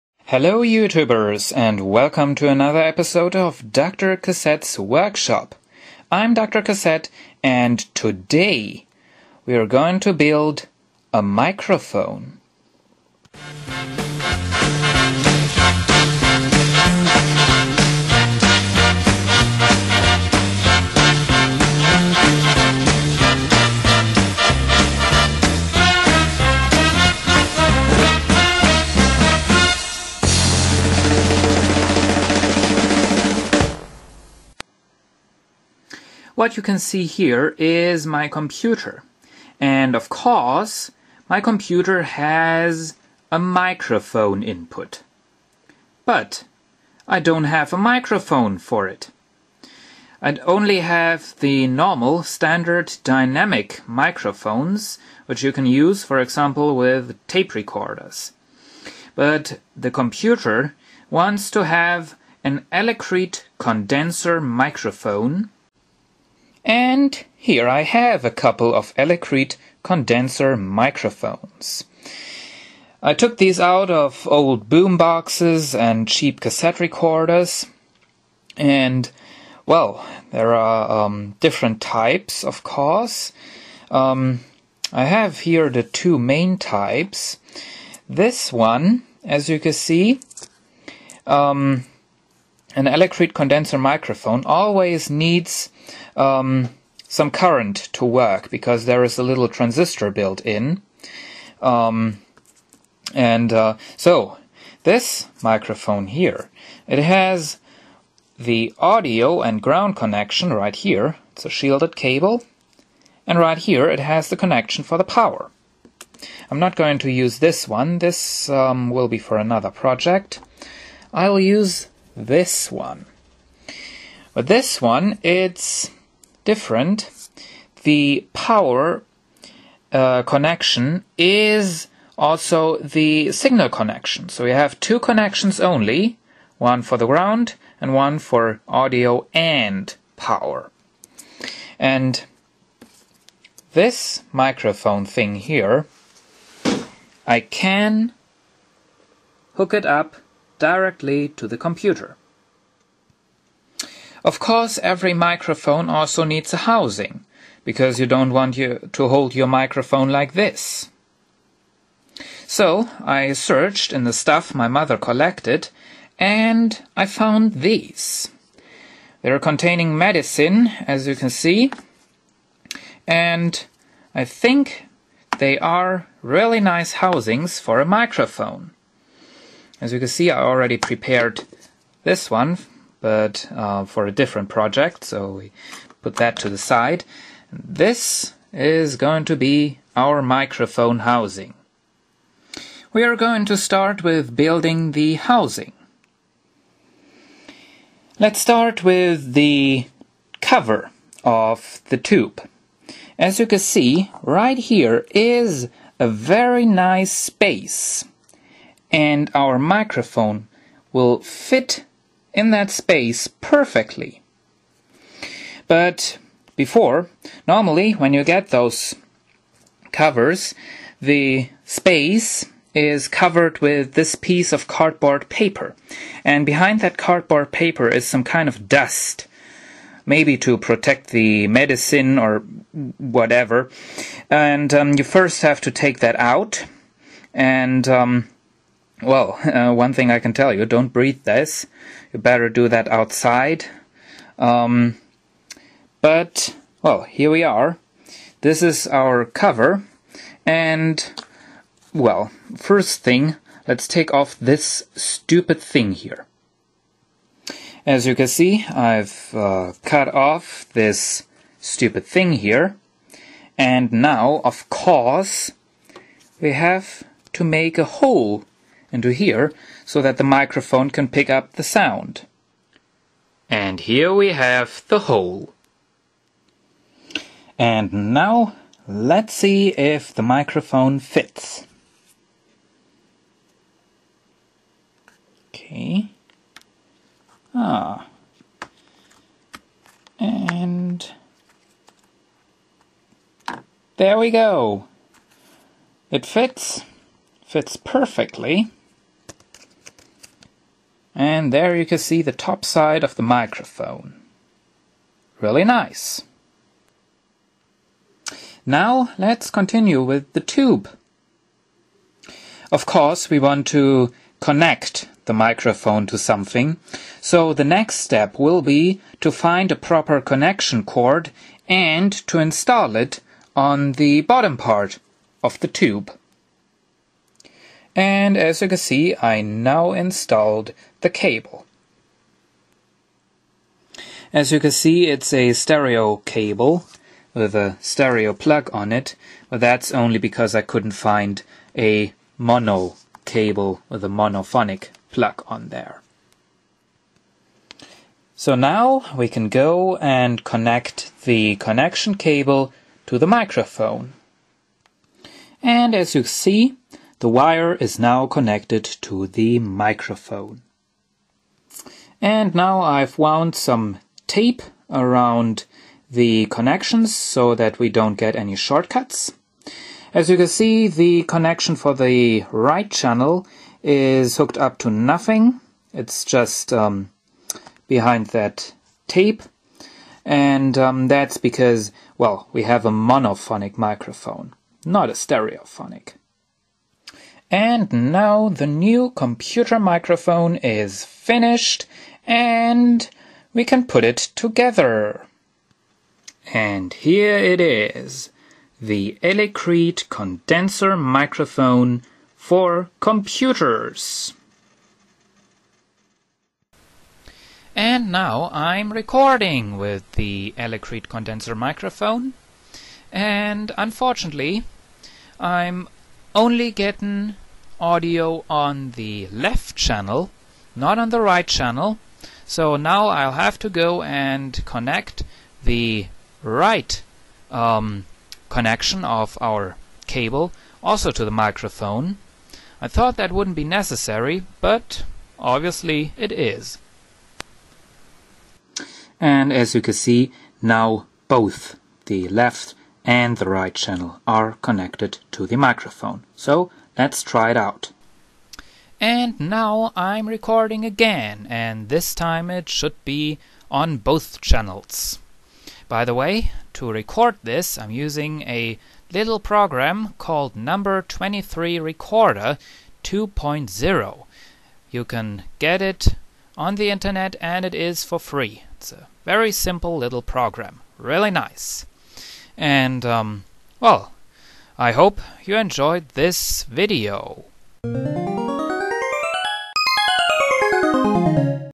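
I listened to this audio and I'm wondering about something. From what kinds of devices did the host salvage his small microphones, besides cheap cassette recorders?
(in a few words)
old boom boxes.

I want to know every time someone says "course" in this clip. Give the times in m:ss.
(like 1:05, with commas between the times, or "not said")
0:40, 1:22, 2:34, 4:24, 5:12.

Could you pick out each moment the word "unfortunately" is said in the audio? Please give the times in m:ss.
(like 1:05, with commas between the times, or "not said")
6:53.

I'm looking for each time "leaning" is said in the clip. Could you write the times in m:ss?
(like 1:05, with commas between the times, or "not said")
not said.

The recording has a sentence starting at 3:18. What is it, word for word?
Let's start with the cover of the tube.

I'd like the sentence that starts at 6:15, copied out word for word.
It's just um, behind that tape.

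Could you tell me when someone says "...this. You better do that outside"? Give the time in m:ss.
4:01.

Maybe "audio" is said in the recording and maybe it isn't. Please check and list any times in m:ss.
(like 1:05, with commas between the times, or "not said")
1:48, 2:18, 6:57.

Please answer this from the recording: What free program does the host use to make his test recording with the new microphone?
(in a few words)
Number 23 Recorder 2.0.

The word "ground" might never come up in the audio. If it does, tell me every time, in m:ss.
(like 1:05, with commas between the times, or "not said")
1:49, 2:17.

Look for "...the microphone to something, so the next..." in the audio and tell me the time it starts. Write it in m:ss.
5:15.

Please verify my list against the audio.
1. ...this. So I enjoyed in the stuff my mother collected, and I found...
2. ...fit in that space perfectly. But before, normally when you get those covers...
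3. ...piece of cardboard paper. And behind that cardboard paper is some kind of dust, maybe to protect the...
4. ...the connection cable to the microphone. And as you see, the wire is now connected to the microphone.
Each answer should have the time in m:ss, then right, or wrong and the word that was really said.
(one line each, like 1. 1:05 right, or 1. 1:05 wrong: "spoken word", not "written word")
1. 2:40 wrong: "searched", not "enjoyed"
2. 3:31 right
3. 3:44 right
4. 5:51 right.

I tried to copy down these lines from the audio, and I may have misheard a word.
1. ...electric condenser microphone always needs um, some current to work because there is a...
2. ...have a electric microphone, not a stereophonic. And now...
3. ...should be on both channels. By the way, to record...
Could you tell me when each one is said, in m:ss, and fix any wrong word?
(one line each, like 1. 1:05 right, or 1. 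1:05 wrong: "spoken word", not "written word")
1. 1:32 right
2. 6:22 wrong: "monophonic", not "electric"
3. 7:32 right.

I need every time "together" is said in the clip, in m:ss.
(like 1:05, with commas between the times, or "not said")
6:34.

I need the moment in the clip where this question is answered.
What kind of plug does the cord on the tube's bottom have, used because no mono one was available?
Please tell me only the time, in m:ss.
5:37.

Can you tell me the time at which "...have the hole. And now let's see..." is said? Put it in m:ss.
4:34.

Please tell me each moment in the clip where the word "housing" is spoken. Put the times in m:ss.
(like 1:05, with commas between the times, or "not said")
2:36, 2:57, 3:10, 3:15.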